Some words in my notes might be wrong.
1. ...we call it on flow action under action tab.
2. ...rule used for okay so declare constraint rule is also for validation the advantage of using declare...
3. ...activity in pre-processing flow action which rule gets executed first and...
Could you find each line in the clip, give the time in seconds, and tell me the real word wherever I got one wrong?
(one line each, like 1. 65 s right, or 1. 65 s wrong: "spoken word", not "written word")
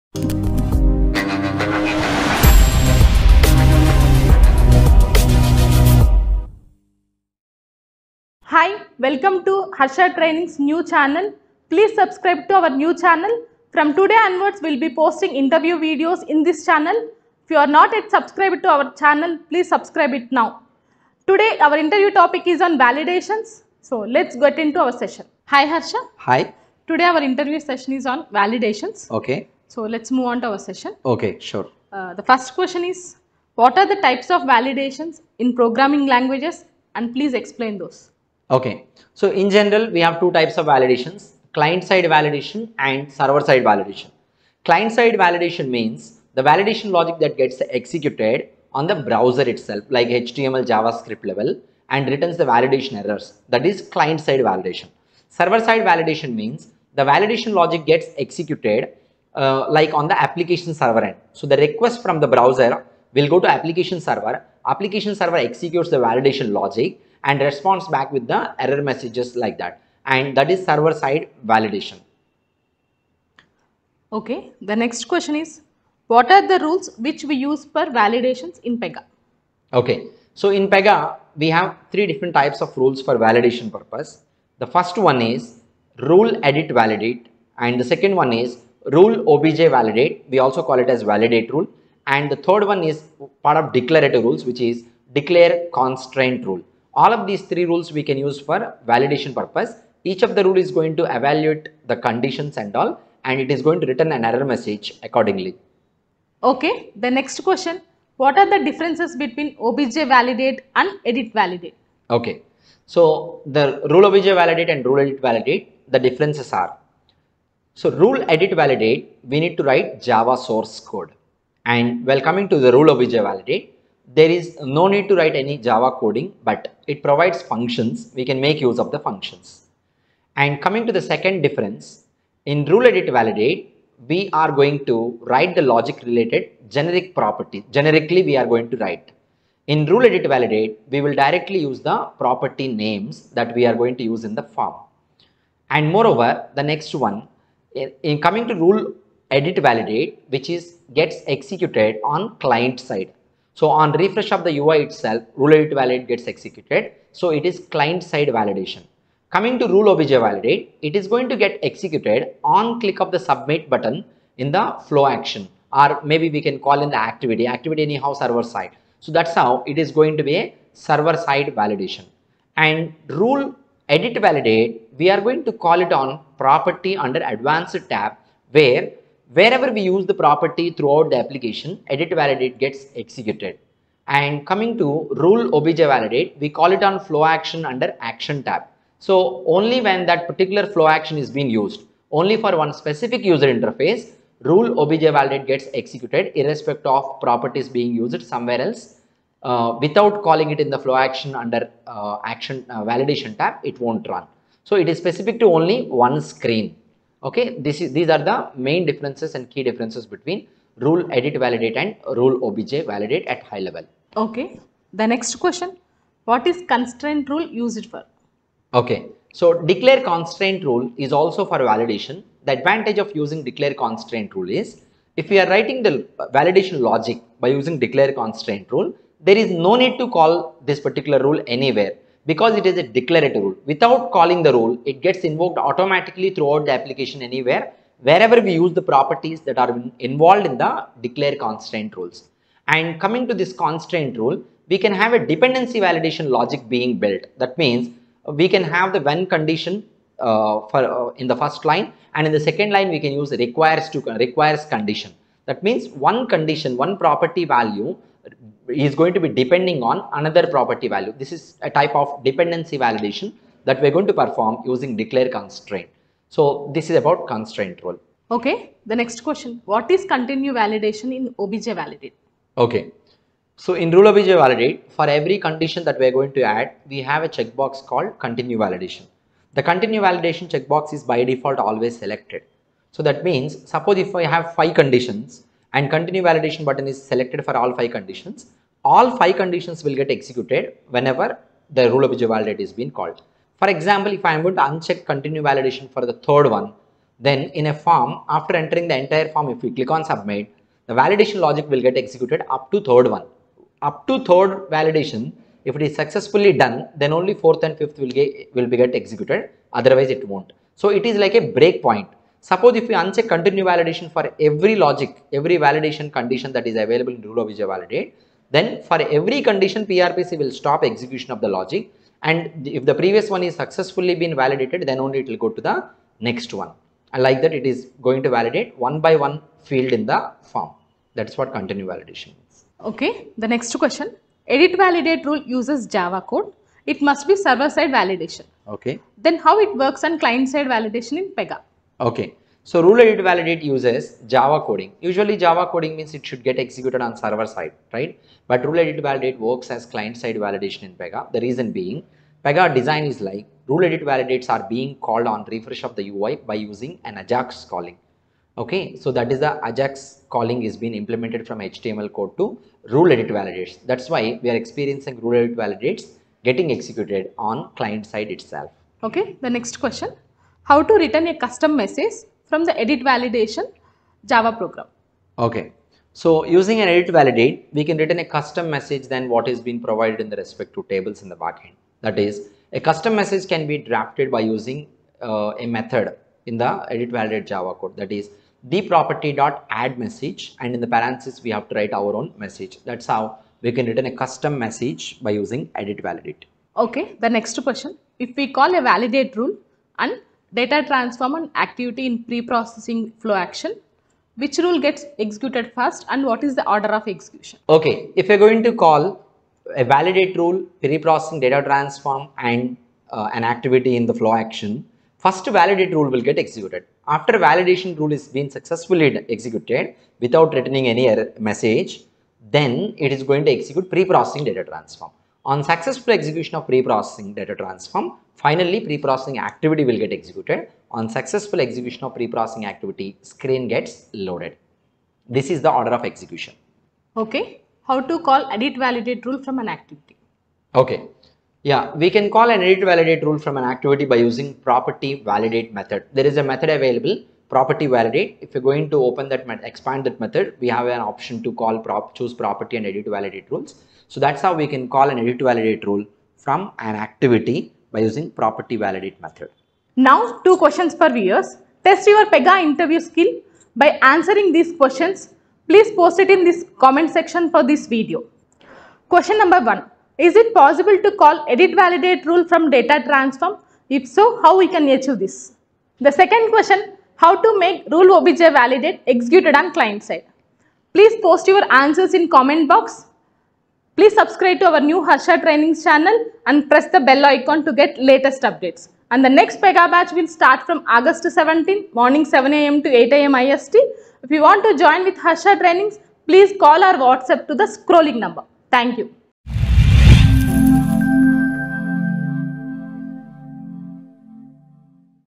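1. 186 s right
2. 217 s right
3. 401 s right.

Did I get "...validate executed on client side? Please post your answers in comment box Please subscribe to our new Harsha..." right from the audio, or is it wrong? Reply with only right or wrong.
right.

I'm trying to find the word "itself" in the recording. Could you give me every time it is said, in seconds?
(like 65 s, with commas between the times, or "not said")
49 s, 154 s, 368 s.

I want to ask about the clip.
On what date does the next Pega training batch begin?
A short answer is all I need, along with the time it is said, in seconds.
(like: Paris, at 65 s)
August 17, at 490 s.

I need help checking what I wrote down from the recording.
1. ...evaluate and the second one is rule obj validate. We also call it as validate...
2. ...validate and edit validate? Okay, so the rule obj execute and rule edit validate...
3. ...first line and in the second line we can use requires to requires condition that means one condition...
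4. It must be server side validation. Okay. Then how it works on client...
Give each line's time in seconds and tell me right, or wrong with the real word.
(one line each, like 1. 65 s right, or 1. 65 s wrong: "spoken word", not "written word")
1. 86 s wrong: "validate", not "evaluate"
2. 109 s wrong: "validate", not "execute"
3. 251 s right
4. 336 s right.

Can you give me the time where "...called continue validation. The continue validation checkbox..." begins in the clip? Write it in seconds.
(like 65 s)
277 s.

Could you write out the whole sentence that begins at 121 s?
And while coming to the rule obj validate, there is no need to write any Java coding, but it provides functions.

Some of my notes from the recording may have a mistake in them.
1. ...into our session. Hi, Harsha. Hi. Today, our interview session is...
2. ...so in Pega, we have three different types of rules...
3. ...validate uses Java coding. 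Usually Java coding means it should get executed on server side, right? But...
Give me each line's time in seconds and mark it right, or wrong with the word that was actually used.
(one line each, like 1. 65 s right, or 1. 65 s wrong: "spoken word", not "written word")
1. 24 s right
2. 80 s right
3. 343 s right.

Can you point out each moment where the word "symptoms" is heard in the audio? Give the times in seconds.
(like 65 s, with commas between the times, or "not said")
not said.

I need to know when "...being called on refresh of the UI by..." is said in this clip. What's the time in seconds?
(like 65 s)
354 s.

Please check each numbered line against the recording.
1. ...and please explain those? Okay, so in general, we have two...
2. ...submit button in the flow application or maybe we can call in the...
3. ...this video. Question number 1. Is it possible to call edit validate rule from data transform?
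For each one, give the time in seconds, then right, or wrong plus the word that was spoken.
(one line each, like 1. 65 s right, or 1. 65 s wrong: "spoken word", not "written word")
1. 36 s right
2. 163 s wrong: "action", not "application"
3. 467 s right.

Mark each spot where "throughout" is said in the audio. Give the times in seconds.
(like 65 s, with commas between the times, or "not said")
180 s, 236 s.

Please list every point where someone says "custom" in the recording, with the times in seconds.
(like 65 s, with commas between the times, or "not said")
371 s, 378 s, 382 s, 394 s.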